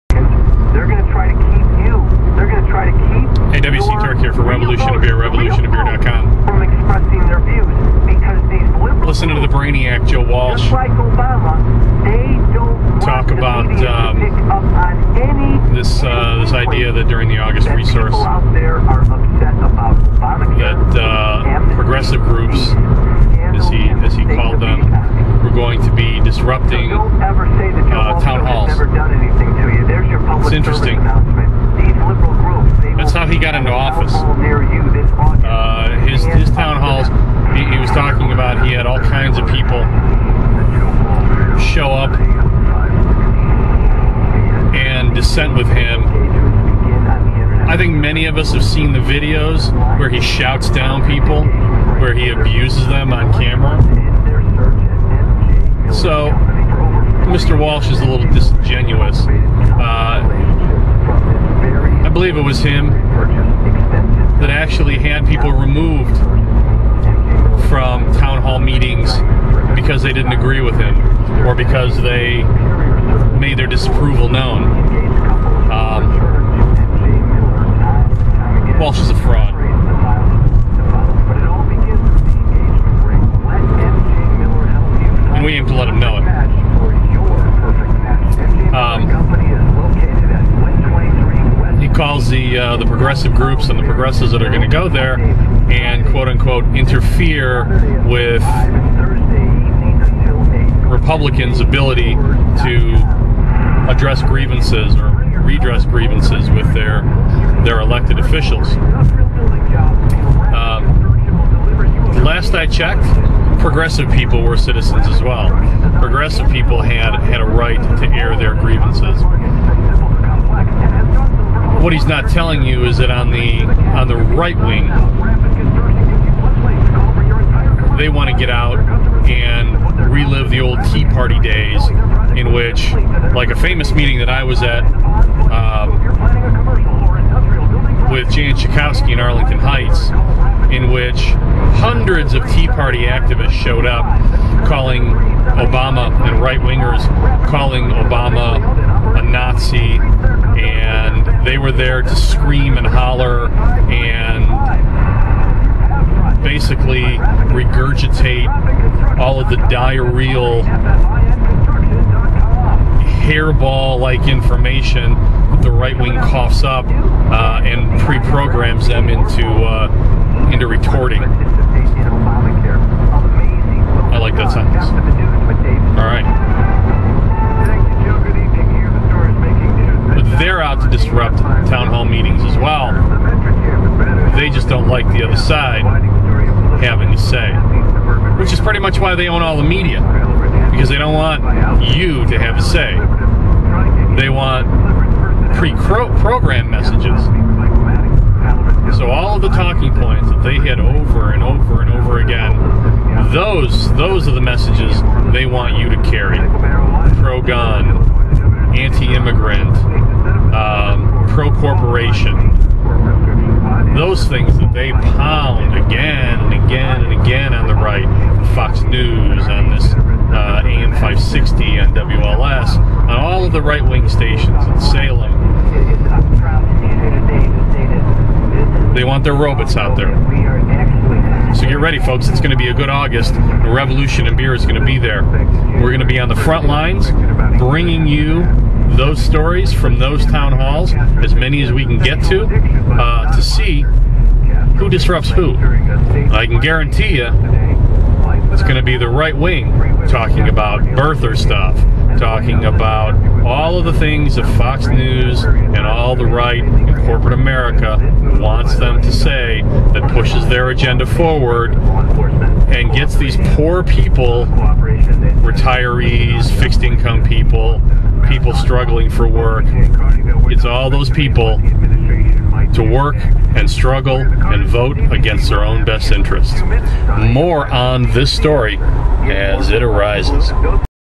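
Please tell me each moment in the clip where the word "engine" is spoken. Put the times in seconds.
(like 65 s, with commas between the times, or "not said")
not said.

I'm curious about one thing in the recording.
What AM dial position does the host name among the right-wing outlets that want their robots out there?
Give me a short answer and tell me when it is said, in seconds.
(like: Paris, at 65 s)
560, at 220 s.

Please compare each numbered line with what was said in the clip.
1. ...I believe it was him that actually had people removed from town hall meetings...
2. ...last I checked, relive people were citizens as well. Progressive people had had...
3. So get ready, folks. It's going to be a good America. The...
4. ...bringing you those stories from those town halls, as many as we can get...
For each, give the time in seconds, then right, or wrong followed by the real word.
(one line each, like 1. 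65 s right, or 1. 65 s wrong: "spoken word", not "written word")
1. 62 s right
2. 112 s wrong: "progressive", not "relive"
3. 231 s wrong: "August", not "America"
4. 237 s right.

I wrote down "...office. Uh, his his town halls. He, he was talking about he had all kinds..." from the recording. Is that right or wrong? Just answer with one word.
right.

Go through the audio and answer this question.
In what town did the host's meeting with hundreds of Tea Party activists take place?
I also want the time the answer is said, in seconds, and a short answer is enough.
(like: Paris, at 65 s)
Arlington Heights, at 139 s.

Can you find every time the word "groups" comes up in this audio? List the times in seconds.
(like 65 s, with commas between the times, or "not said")
22 s, 93 s.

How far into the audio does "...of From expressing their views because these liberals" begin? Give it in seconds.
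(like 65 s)
5 s.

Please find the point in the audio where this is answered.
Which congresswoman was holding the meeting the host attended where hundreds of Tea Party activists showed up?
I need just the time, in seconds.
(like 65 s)
138 s.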